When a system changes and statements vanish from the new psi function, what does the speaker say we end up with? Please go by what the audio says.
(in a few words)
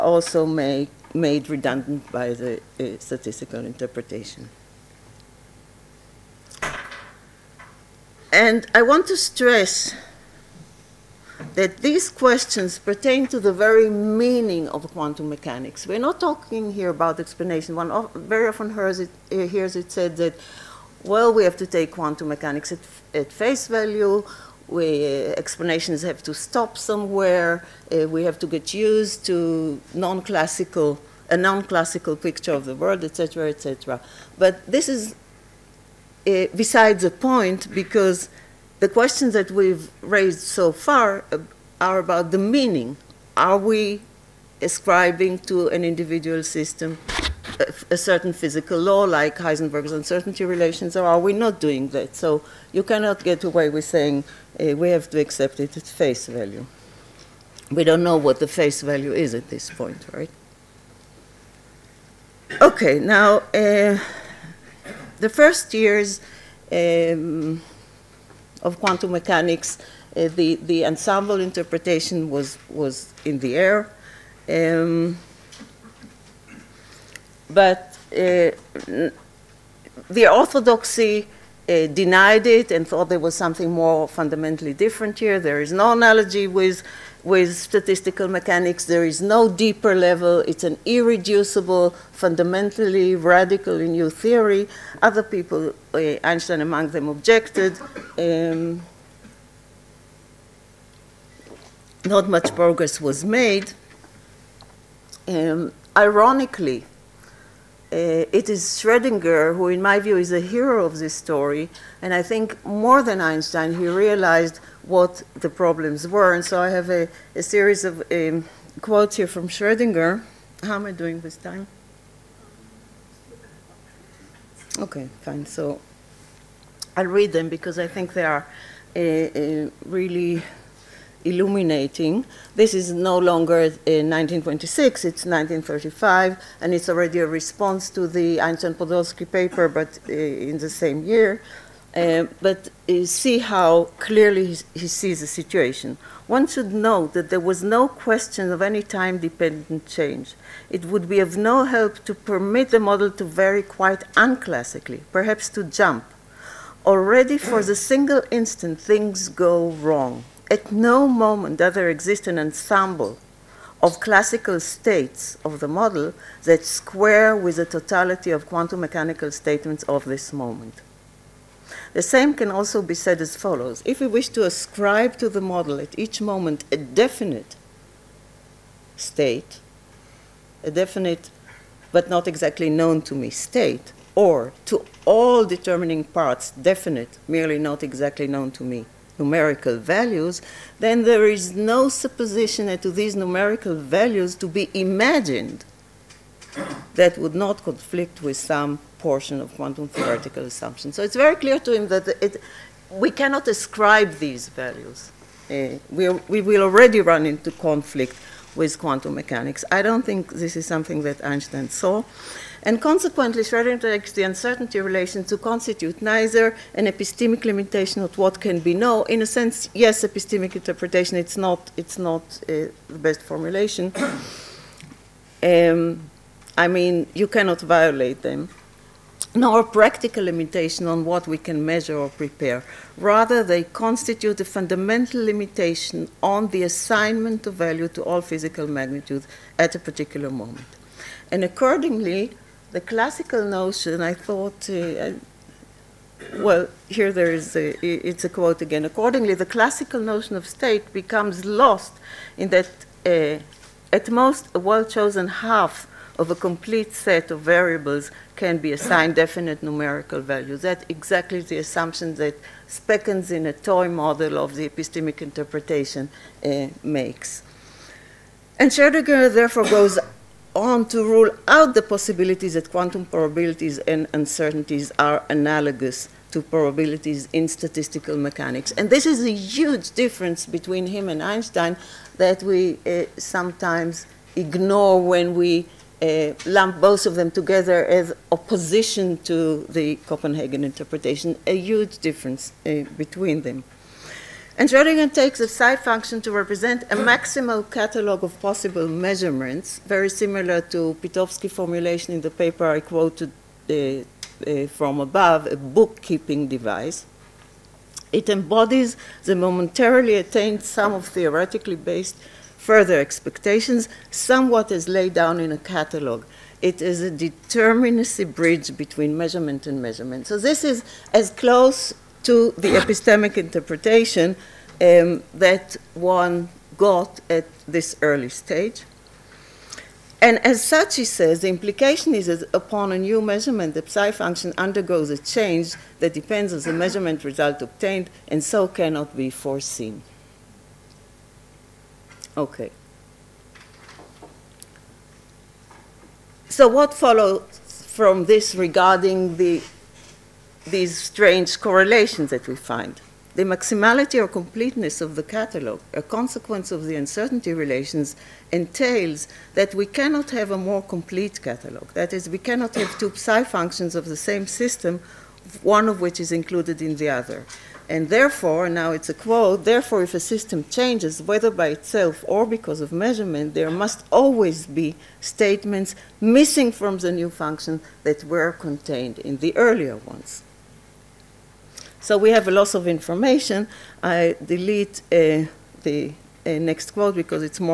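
a loss of information.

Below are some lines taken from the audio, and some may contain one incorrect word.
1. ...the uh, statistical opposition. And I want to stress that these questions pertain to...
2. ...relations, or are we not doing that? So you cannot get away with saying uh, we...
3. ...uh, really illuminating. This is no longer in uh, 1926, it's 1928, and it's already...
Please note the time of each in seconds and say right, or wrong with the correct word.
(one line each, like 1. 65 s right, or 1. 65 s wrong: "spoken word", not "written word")
1. 2 s wrong: "interpretation", not "opposition"
2. 50 s right
3. 128 s wrong: "1935", not "1928".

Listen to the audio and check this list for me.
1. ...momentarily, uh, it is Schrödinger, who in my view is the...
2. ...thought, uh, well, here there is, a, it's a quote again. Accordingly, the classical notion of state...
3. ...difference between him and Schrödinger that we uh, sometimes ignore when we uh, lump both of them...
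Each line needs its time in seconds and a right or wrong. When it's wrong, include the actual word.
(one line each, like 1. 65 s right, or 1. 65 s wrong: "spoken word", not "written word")
1. 105 s wrong: "ironically", not "momentarily"
2. 244 s right
3. 279 s wrong: "Einstein", not "Schrödinger".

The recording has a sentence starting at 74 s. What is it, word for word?
Um, but uh, the orthodoxy uh, denied it and thought there was something more fundamentally different here.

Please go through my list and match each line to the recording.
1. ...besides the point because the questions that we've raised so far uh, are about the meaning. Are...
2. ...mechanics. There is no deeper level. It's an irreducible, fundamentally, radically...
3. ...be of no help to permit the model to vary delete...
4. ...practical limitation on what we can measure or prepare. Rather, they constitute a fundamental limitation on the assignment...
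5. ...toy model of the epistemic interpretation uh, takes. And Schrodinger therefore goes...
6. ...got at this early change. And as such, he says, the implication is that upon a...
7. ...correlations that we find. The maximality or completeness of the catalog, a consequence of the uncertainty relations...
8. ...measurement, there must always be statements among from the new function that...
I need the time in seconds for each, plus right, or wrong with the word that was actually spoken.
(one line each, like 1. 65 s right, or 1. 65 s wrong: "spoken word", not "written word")
1. 36 s right
2. 88 s right
3. 151 s wrong: "quite", not "delete"
4. 229 s right
5. 263 s wrong: "makes", not "takes"
6. 326 s wrong: "stage", not "change"
7. 351 s right
8. 372 s wrong: "missing", not "among".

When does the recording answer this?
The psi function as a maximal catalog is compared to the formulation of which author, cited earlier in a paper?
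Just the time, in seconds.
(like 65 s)
301 s.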